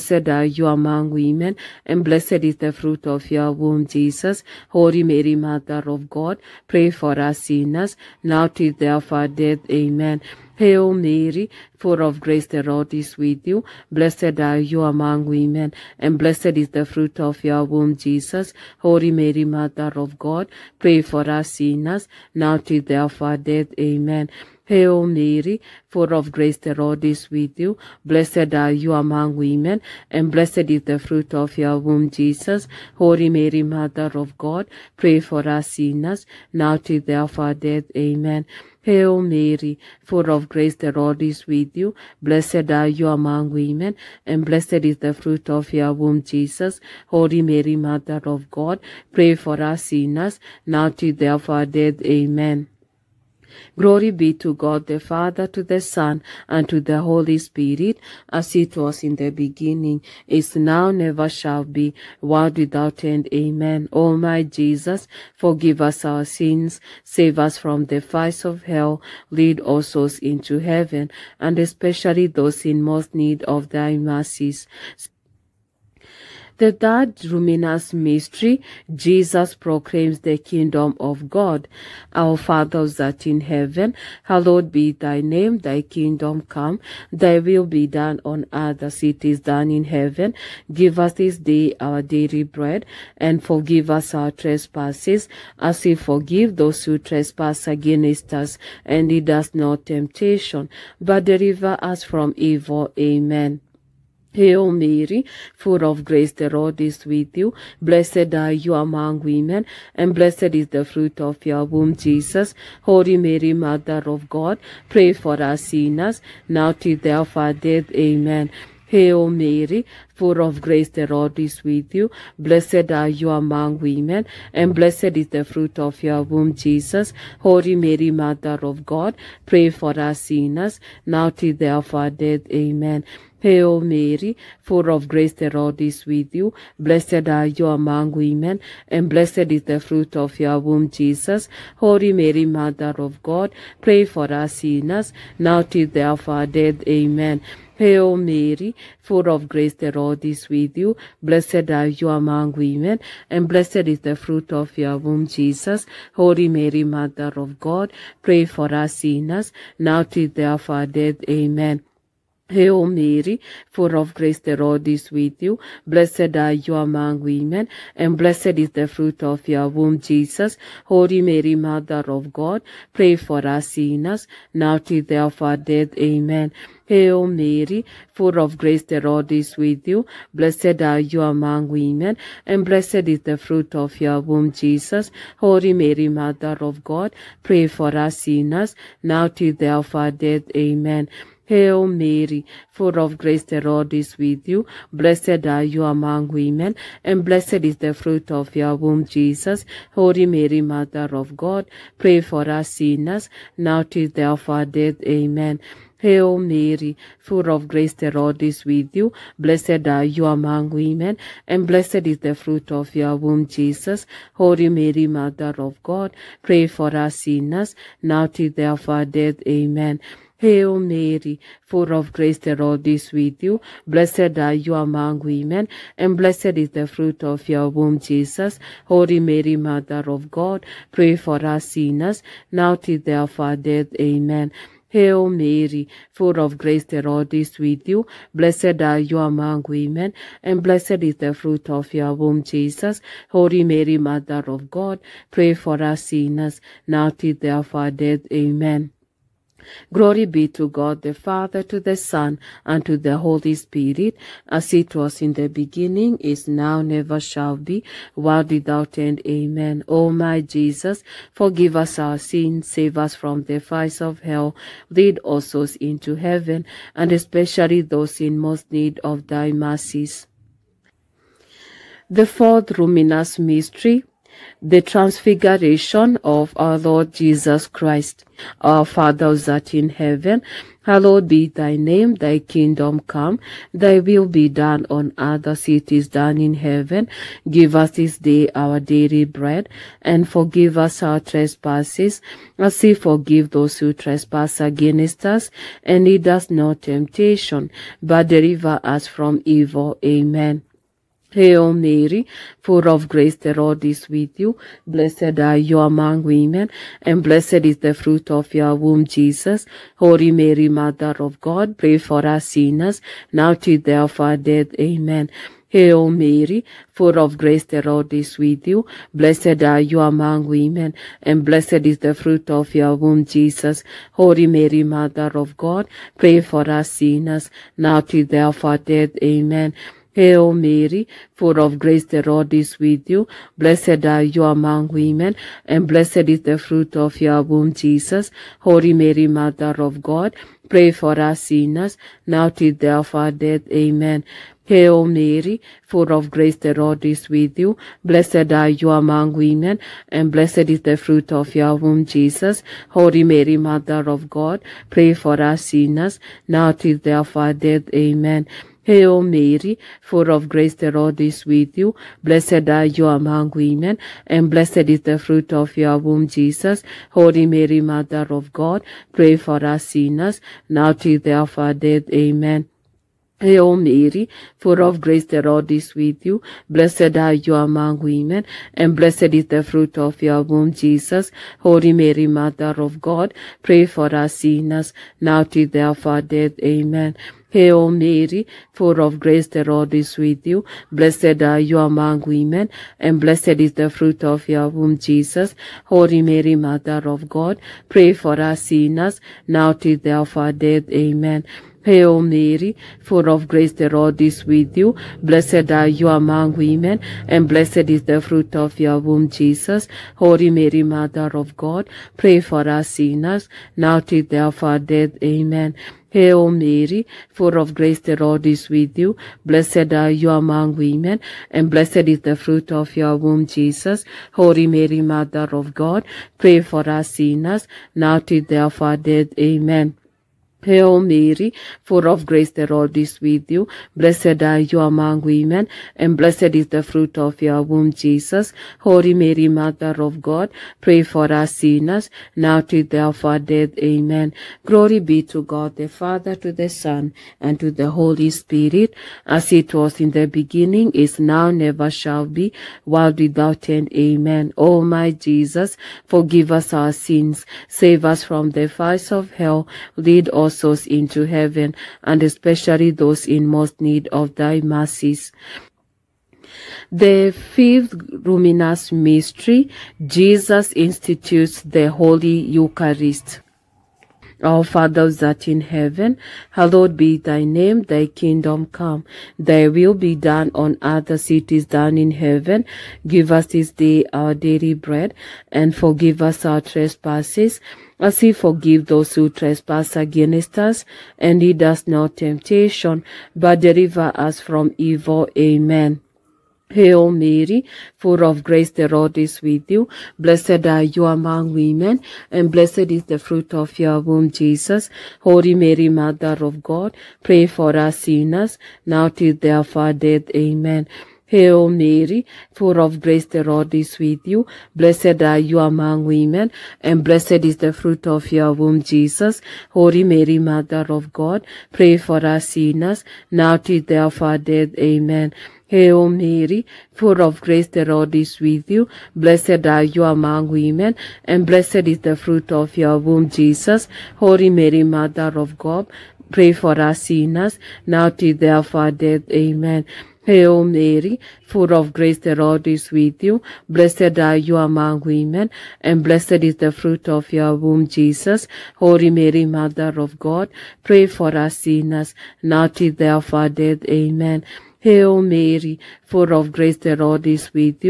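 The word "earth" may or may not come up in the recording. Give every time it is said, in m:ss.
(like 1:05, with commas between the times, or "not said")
1:28, 4:45, 8:00.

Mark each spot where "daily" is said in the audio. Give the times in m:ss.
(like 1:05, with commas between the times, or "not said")
1:32, 4:48, 8:04.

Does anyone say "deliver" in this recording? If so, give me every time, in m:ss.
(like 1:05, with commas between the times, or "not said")
1:41, 4:58, 8:13.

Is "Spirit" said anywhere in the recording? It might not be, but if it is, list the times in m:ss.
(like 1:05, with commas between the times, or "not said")
0:57, 4:13, 7:28.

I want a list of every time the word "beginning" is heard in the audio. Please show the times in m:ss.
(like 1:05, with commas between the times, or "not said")
0:59, 4:15, 7:30.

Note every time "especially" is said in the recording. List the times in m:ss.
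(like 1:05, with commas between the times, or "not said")
1:11, 4:27, 7:42.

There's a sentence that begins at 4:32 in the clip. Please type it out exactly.
The fourth luminous mystery the transfiguration of our Lord Jesus Christ.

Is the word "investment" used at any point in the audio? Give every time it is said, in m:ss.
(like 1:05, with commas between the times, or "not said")
not said.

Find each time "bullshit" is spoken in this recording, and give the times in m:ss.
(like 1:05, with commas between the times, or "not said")
not said.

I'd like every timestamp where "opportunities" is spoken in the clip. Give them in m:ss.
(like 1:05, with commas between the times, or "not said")
not said.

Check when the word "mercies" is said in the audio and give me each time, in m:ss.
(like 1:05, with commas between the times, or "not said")
1:13, 4:29, 7:44.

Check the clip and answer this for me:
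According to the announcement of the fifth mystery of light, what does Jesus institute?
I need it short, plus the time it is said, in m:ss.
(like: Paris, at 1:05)
The Holy Eucharist, at 7:51.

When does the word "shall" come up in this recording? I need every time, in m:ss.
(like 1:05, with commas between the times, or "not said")
1:01, 4:17, 7:31.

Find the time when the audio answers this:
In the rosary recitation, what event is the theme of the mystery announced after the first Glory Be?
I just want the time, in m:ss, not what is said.
1:18.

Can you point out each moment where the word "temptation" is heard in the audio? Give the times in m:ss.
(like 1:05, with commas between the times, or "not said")
1:39, 4:56, 8:12.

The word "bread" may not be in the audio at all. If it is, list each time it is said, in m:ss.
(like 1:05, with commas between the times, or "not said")
1:32, 4:49, 8:04.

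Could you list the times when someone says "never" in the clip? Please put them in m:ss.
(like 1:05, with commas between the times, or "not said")
1:00, 4:16, 7:31.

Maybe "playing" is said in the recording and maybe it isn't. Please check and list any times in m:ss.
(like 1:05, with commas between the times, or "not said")
not said.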